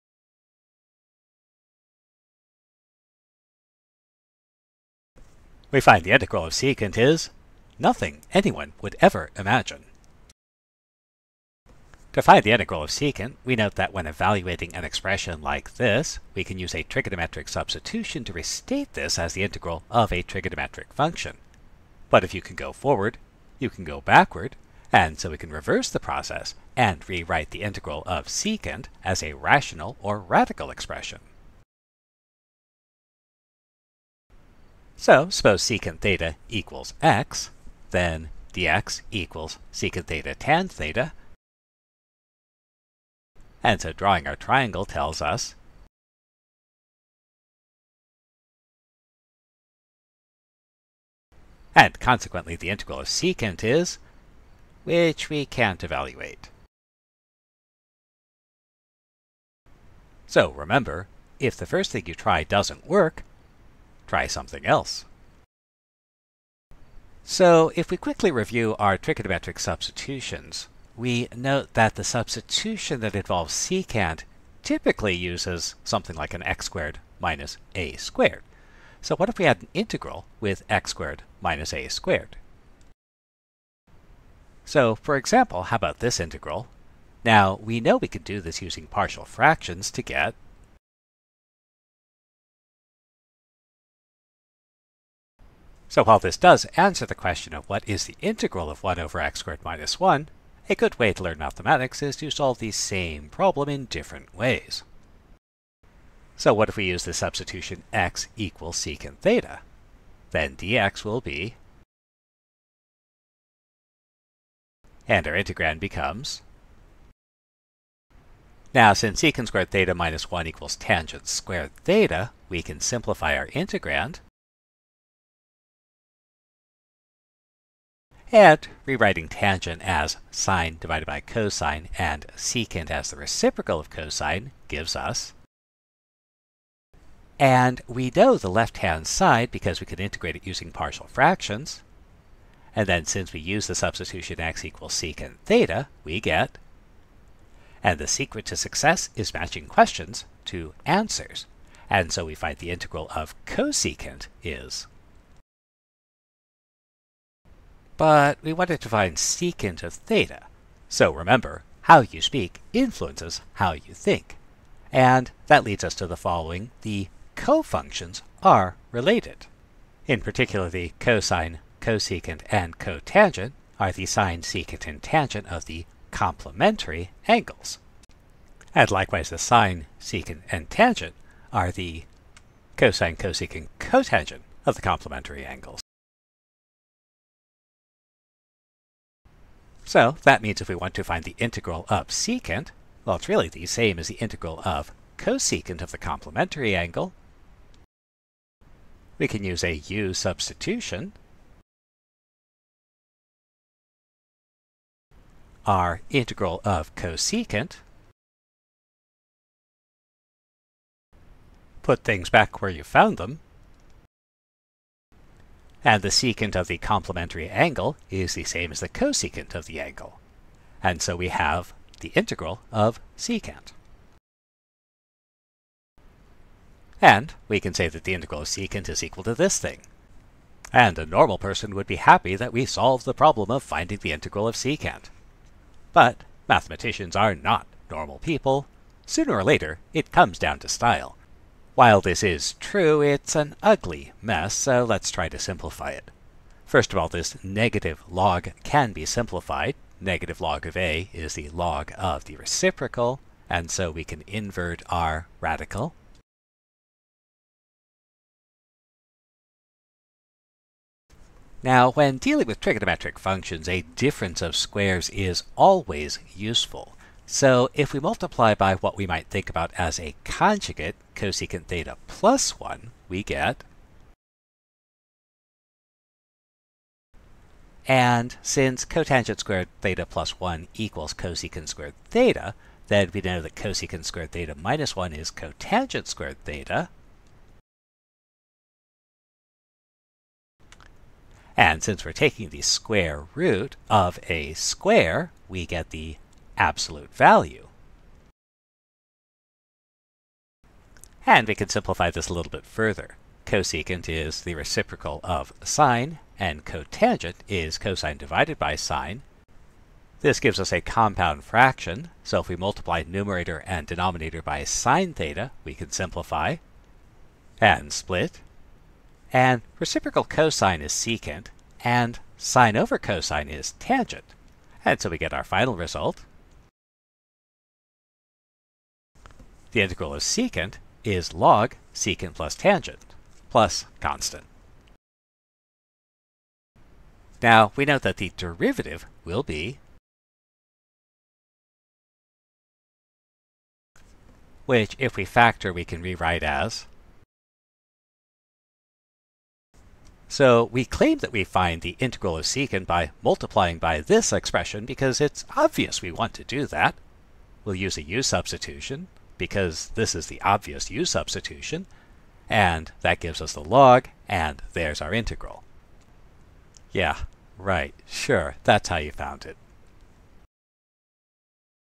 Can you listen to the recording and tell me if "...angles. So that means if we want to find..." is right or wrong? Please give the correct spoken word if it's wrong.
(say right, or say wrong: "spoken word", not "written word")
right.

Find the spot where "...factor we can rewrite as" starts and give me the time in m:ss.
5:45.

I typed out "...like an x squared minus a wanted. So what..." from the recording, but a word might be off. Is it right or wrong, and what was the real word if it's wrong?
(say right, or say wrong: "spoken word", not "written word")
wrong: "squared", not "wanted".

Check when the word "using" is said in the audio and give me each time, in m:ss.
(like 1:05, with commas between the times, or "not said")
1:28, 2:20.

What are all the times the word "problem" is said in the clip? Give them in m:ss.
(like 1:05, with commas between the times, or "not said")
1:43, 3:53.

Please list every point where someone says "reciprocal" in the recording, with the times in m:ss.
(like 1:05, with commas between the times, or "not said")
2:13, 4:12, 5:04, 5:19.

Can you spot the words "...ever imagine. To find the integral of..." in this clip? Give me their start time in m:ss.
0:08.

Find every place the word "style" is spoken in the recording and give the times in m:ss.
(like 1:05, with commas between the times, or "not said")
4:00.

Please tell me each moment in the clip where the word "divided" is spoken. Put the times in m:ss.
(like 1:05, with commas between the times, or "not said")
2:10, 5:08.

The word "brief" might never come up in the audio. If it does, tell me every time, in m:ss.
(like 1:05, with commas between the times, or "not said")
not said.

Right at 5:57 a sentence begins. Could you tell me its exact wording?
We'll use a u substitution because this is the obvious u substitution, and that gives us the log, and there's our integral.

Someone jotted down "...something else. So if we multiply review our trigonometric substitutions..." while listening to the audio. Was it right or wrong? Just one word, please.
wrong.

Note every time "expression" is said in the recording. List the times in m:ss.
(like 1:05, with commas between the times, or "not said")
0:14, 0:30, 5:54.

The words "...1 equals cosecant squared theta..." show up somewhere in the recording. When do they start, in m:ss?
4:40.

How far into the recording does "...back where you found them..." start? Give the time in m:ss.
3:32.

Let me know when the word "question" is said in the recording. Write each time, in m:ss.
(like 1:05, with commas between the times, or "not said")
1:37, 2:29.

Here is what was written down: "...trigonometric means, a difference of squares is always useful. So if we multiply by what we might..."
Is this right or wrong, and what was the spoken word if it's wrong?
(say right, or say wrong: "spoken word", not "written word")
wrong: "functions", not "means".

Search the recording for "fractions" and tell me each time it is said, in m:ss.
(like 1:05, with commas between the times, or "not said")
1:29, 2:21, 5:11.